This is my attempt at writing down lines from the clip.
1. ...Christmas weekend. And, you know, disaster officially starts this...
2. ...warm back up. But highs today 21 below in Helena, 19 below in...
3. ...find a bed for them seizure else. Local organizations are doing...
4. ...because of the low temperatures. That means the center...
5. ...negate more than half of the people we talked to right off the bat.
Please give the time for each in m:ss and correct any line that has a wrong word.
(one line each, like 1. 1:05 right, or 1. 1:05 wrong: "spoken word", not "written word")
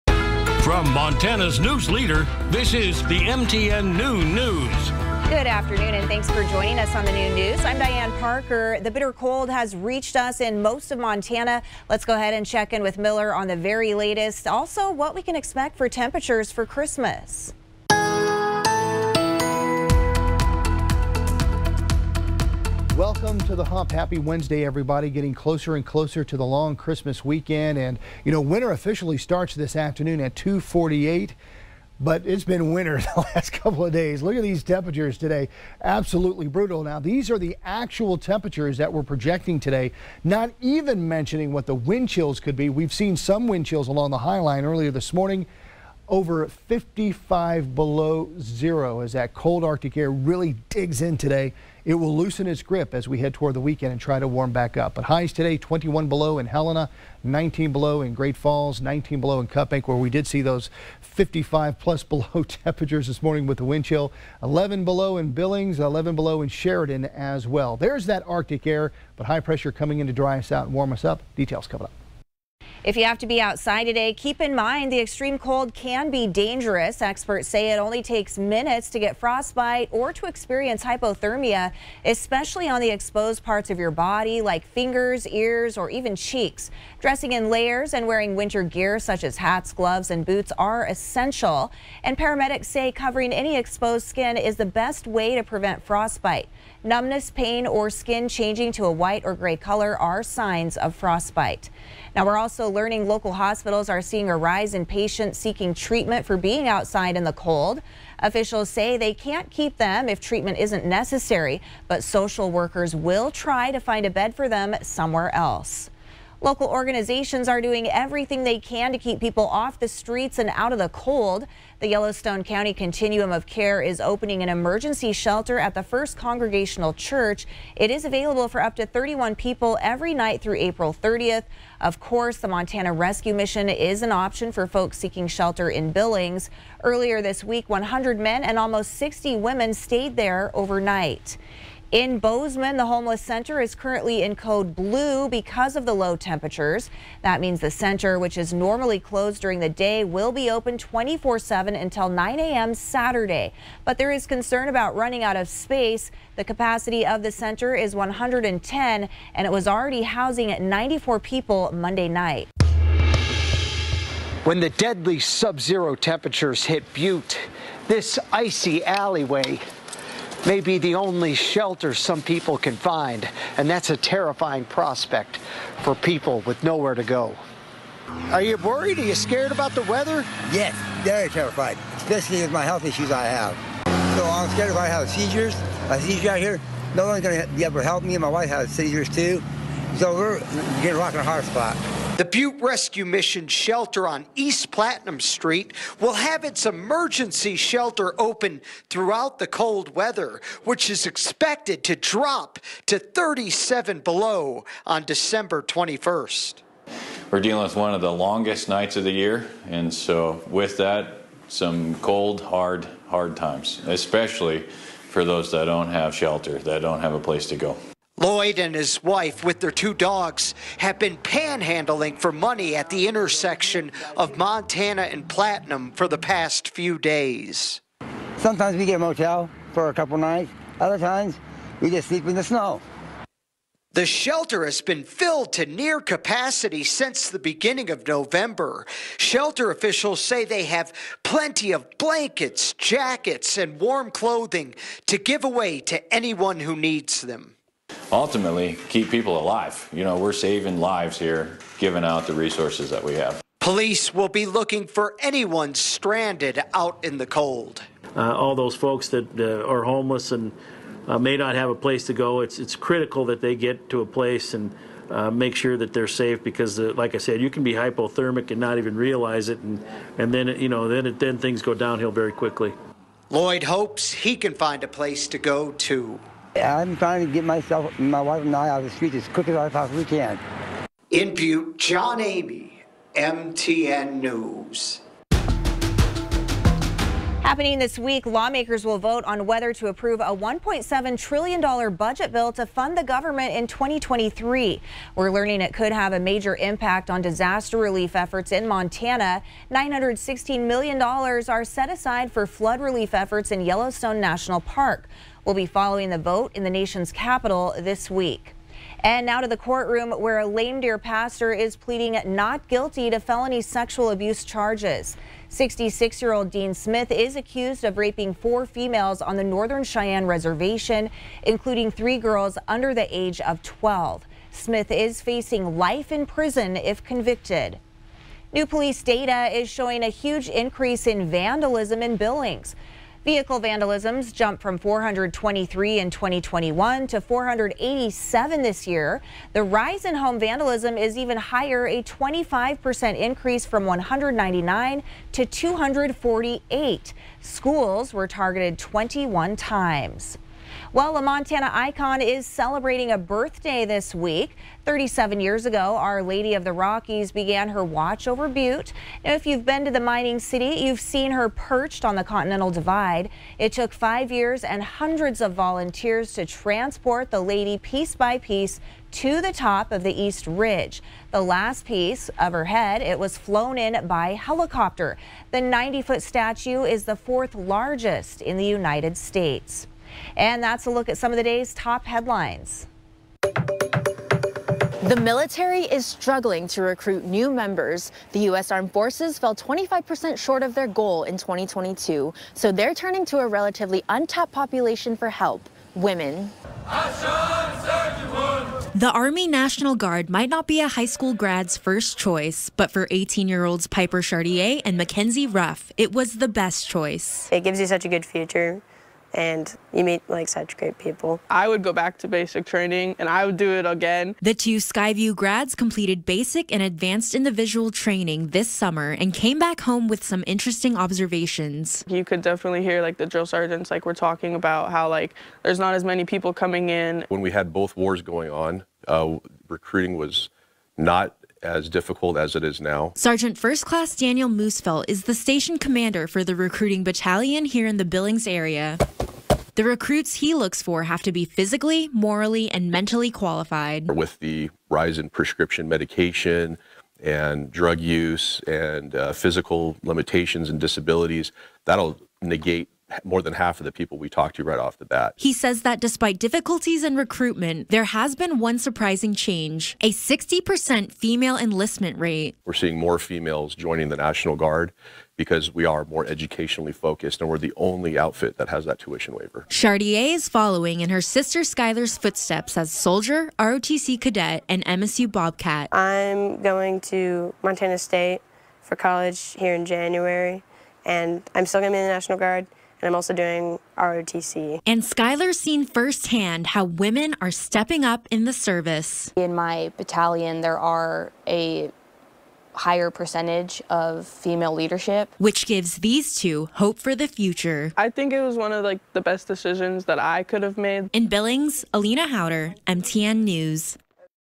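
1. 0:26 wrong: "winter", not "disaster"
2. 0:54 right
3. 1:53 wrong: "somewhere", not "seizure"
4. 2:25 right
5. 7:32 right.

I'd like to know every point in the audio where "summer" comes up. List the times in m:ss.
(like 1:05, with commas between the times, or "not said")
6:58.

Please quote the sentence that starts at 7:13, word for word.
Sergeant First Class Daniel Moosefelt is the station commander for the recruiting battalion here in the Billings area.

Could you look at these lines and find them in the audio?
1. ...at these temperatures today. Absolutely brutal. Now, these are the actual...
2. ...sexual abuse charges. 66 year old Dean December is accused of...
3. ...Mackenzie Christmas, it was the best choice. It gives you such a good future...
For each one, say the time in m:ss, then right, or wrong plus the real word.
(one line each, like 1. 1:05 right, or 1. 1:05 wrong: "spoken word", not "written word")
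1. 0:34 right
2. 5:13 wrong: "Smith", not "December"
3. 6:44 wrong: "Ruff", not "Christmas".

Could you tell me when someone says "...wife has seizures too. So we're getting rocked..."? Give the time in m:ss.
3:08.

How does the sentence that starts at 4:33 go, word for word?
Lloyd hopes he can find a place to go too.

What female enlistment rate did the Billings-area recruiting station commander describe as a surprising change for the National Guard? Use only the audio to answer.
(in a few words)
60%.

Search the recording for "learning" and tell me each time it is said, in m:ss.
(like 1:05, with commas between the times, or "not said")
1:42, 4:55.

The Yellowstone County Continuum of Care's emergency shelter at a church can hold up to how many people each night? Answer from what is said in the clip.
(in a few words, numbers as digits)
31.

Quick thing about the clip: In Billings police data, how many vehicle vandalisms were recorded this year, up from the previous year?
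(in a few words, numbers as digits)
487.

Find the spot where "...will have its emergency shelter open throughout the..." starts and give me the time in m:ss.
3:15.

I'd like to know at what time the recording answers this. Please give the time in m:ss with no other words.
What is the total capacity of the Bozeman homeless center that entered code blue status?
2:37.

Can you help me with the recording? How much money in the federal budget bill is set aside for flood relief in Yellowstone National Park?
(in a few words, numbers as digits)
$916 million.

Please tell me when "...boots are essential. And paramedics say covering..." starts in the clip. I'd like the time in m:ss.
1:30.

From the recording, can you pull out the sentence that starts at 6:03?
It took five years and hundreds of volunteers to transport the lady piece by piece to the top of the East Ridge.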